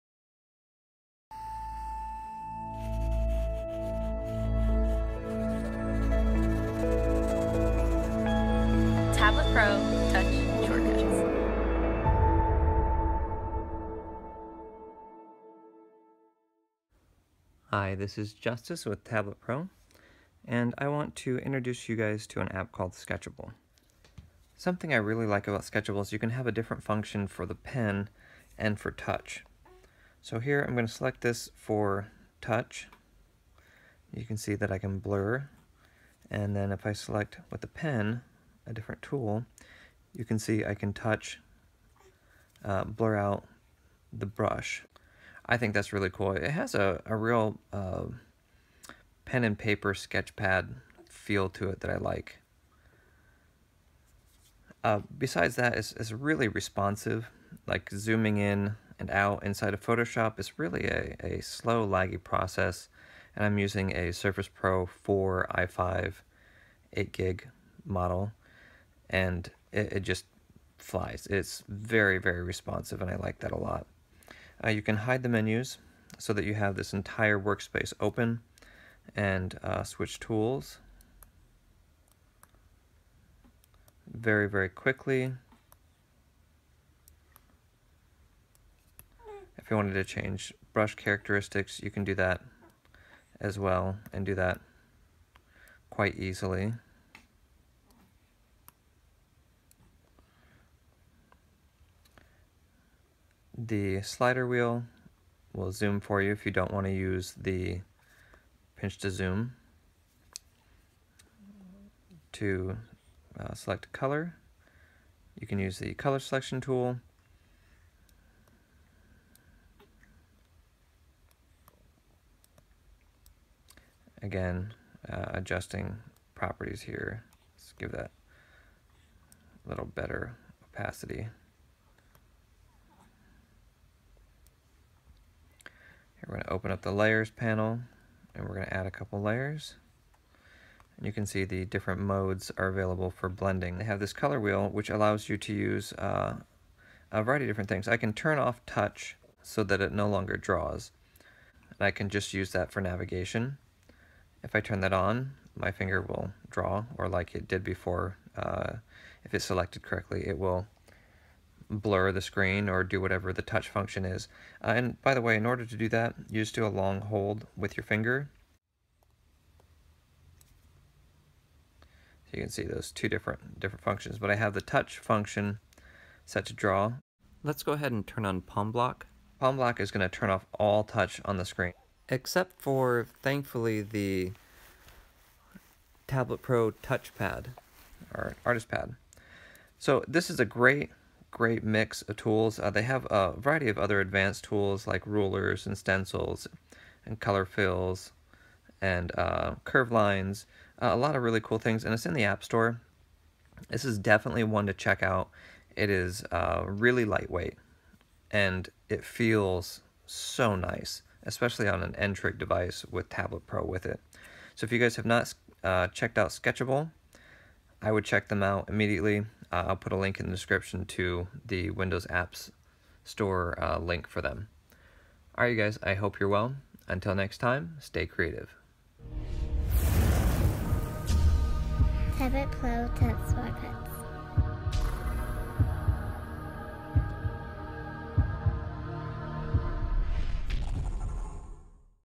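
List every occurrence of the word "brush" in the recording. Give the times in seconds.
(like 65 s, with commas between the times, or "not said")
44 s, 90 s.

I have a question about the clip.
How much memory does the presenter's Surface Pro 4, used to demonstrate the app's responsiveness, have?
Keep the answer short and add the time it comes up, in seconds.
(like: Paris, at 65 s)
8 gig, at 66 s.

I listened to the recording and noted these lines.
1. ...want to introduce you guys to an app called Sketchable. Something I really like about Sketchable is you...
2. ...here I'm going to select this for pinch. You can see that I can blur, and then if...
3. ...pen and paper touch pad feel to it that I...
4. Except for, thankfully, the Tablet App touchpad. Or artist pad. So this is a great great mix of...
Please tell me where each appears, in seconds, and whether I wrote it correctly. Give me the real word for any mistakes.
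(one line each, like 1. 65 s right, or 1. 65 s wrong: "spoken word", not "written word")
1. 20 s right
2. 30 s wrong: "touch", not "pinch"
3. 49 s wrong: "sketch", not "touch"
4. 182 s wrong: "Pro", not "App".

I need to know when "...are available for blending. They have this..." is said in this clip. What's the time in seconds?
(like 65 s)
142 s.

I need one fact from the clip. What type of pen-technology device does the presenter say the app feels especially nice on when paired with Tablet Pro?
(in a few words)
N-Trig.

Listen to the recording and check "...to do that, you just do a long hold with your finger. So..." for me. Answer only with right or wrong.
right.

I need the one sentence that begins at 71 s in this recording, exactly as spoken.
It's very, very responsive, and I like that a lot.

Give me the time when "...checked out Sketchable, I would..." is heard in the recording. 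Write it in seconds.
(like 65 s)
215 s.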